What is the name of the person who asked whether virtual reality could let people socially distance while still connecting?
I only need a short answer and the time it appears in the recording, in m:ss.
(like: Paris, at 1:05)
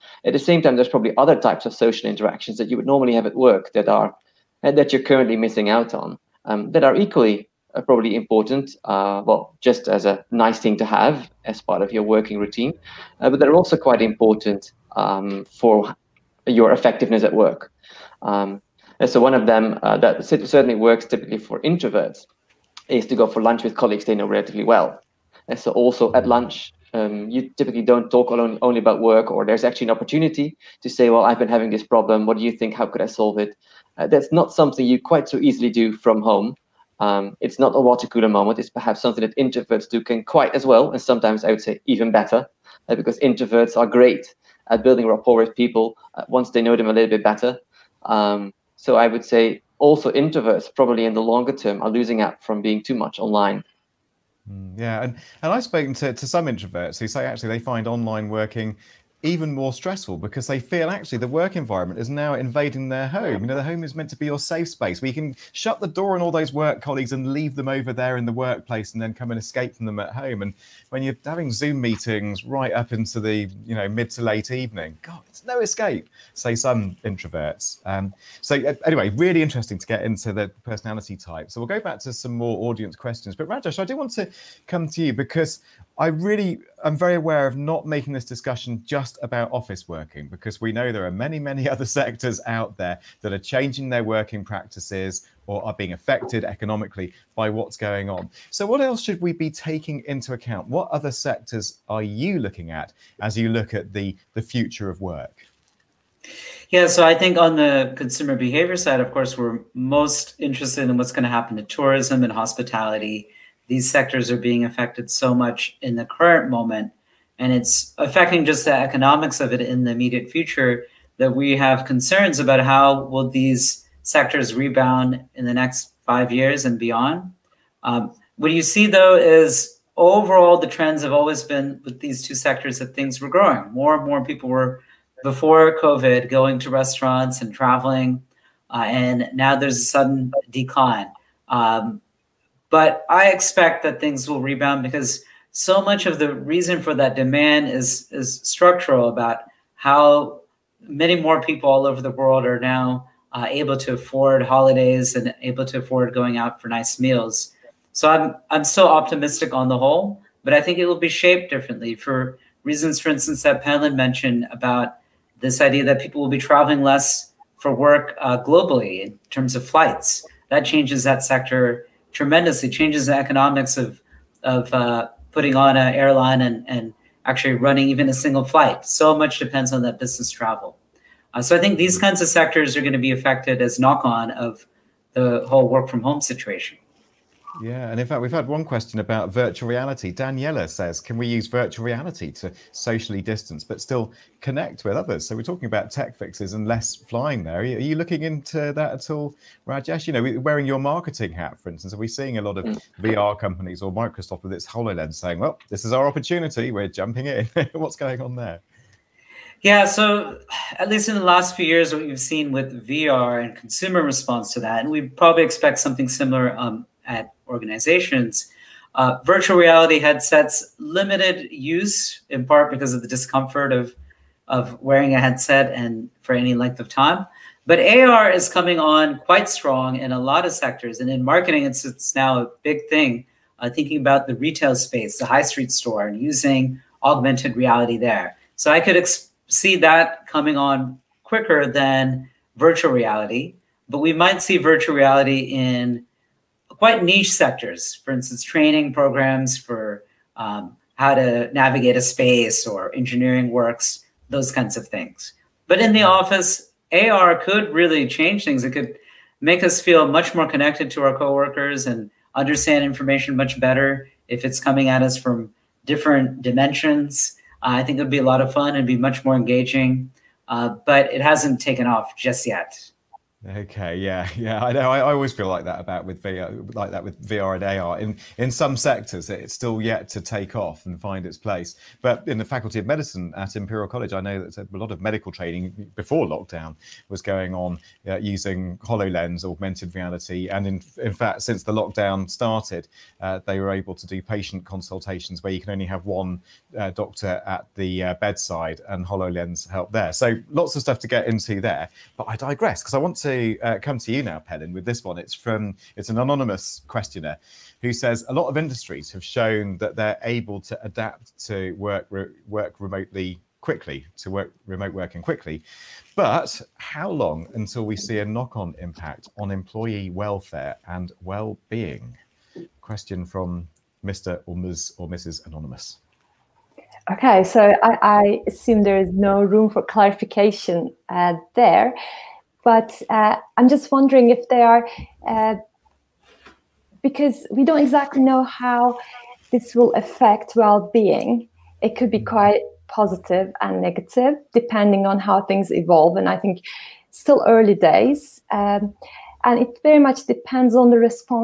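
Daniela, at 3:10.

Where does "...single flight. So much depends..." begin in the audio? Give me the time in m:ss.
2:58.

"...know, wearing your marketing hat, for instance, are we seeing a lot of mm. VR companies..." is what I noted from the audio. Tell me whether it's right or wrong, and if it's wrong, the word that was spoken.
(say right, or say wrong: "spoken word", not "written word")
right.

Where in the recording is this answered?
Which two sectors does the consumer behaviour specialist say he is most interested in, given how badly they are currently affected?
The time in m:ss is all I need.
1:51.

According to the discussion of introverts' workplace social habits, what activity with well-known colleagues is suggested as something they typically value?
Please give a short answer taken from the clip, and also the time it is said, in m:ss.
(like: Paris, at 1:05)
Go for lunch, at 0:23.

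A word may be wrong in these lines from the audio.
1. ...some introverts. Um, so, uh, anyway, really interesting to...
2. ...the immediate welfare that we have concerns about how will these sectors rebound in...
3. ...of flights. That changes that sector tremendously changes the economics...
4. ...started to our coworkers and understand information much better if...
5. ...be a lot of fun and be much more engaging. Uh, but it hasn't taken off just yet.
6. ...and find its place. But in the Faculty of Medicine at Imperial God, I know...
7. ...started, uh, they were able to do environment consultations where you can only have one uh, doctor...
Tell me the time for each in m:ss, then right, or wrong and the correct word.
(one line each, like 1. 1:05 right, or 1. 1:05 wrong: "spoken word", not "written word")
1. 1:16 right
2. 1:59 wrong: "future", not "welfare"
3. 2:49 right
4. 4:20 wrong: "connected", not "started"
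5. 4:28 right
6. 4:40 wrong: "College", not "God"
7. 4:52 wrong: "patient", not "environment".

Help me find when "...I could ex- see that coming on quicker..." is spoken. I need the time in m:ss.
3:58.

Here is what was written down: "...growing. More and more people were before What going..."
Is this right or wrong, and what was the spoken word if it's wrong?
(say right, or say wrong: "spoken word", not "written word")
wrong: "COVID", not "What".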